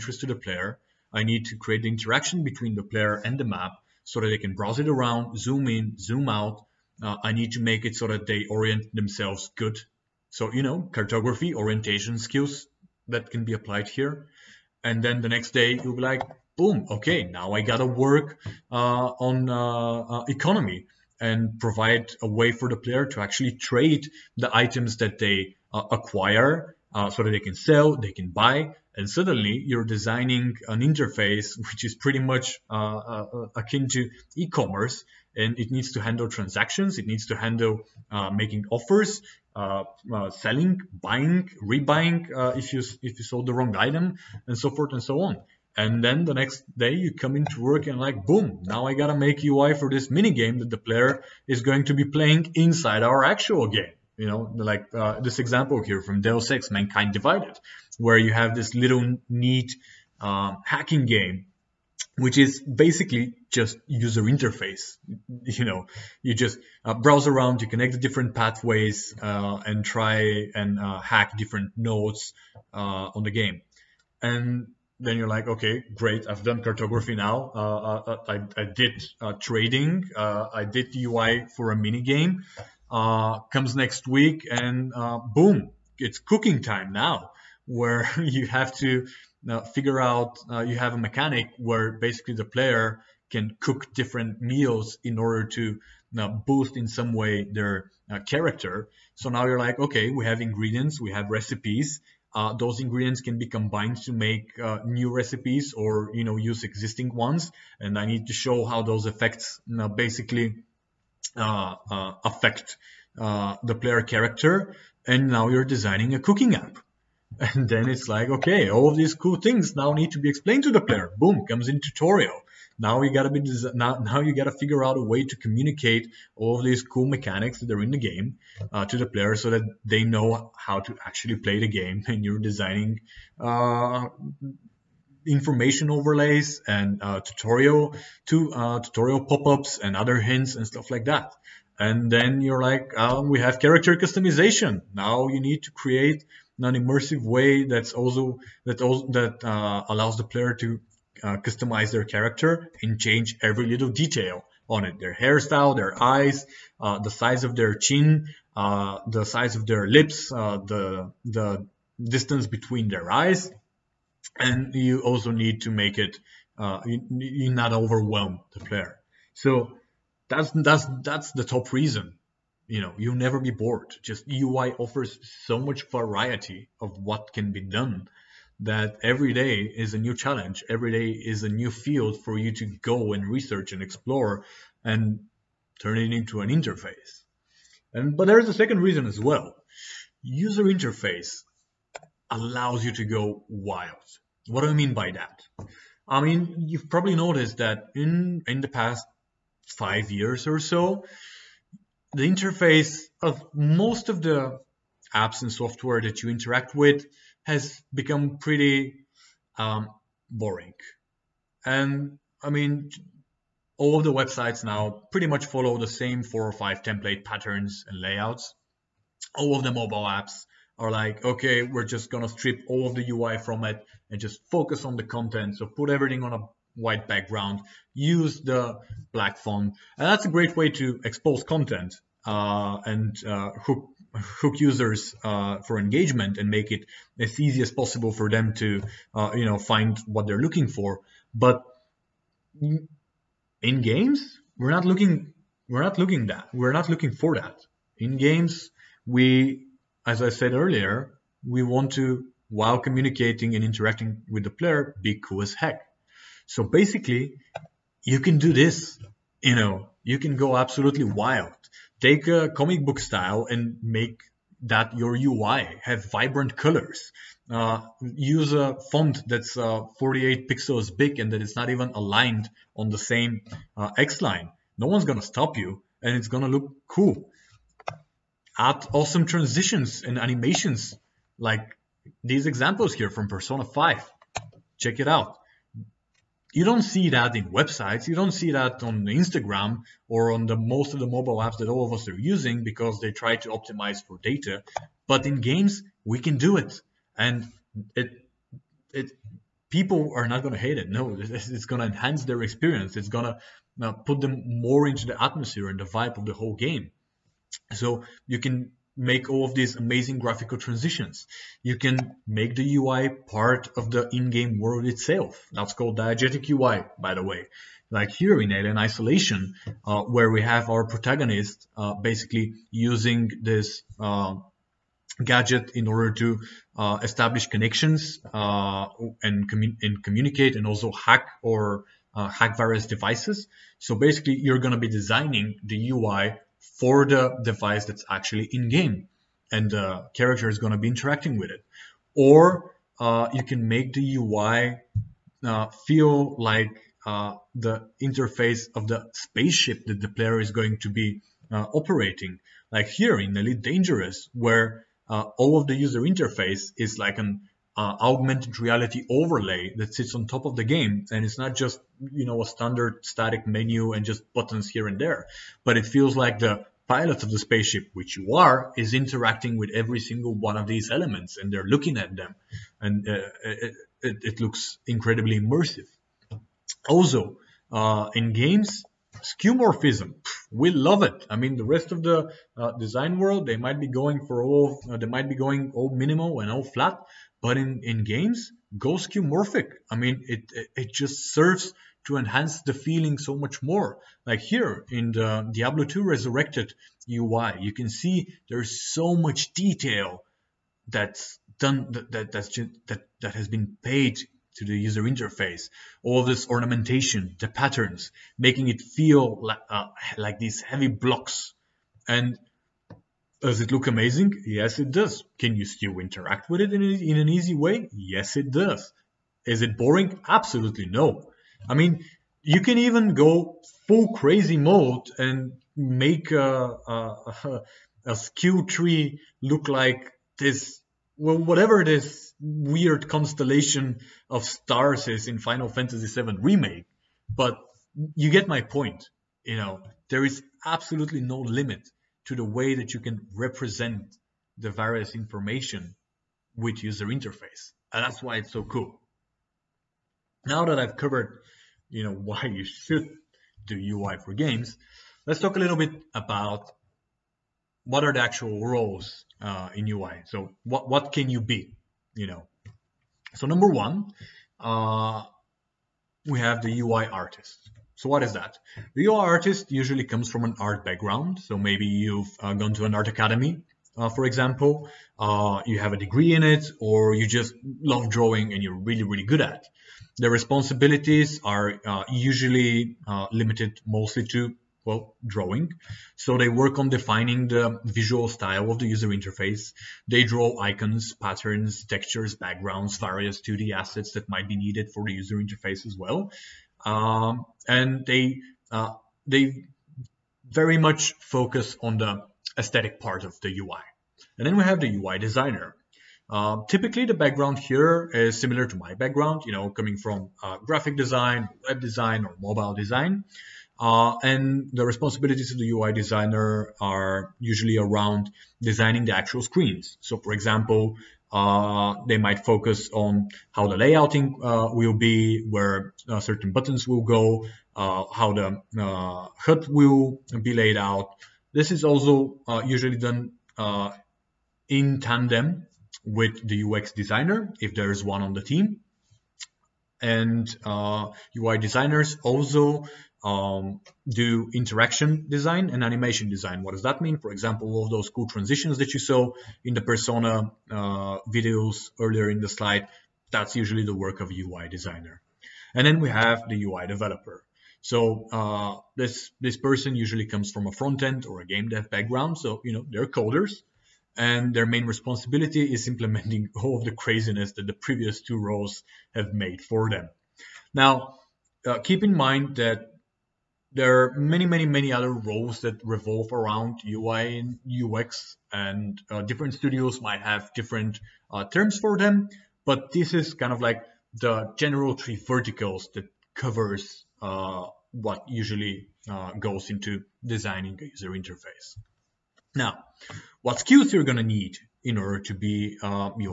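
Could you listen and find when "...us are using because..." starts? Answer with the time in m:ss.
4:51.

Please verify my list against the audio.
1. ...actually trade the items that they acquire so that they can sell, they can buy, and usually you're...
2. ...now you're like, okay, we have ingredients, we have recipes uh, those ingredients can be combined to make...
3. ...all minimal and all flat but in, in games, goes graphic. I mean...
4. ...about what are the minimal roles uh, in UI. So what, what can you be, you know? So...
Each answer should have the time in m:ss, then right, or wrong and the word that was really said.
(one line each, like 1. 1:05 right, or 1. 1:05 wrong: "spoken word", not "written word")
1. 0:23 wrong: "suddenly", not "usually"
2. 1:39 right
3. 6:25 wrong: "skeuomorphic", not "graphic"
4. 7:36 wrong: "actual", not "minimal".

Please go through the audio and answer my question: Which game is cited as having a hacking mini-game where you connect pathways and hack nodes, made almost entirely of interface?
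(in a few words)
Deus Ex Mankind Divided.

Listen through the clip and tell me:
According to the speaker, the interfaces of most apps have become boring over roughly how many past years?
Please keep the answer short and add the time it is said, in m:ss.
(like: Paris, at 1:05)
5 years, at 3:19.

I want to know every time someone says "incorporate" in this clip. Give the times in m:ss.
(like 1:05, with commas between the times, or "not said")
not said.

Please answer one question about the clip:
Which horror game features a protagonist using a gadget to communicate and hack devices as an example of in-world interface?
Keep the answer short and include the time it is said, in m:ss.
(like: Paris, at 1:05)
Alien Isolation, at 5:18.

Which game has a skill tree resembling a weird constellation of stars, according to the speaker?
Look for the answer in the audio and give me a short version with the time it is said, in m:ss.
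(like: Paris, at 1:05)
Final Fantasy VII Remake, at 7:15.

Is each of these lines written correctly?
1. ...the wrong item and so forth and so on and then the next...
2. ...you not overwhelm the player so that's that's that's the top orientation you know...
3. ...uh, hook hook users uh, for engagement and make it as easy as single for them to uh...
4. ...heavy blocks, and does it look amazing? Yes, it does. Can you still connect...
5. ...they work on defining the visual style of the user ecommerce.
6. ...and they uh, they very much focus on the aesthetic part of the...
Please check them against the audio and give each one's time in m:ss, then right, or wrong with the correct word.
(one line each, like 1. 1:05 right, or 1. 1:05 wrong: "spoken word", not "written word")
1. 0:43 right
2. 2:47 wrong: "reason", not "orientation"
3. 3:53 wrong: "possible", not "single"
4. 6:50 wrong: "interact", not "connect"
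5. 8:06 wrong: "interface", not "ecommerce"
6. 8:17 right.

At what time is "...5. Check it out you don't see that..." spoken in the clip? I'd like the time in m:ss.
4:43.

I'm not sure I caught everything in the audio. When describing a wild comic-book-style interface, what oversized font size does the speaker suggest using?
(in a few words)
48 pixels.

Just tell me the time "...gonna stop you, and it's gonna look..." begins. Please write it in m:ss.
4:35.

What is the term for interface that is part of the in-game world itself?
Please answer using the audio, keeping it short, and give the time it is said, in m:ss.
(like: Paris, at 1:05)
diegetic UI, at 5:15.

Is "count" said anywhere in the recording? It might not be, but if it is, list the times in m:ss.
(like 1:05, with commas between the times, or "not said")
not said.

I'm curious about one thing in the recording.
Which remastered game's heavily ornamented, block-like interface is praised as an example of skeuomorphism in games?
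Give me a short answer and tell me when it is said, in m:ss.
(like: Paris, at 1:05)
Diablo 2 Resurrected, at 6:35.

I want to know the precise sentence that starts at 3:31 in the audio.
And I mean, all of the websites now pretty much follow the same four or five template patterns and layouts.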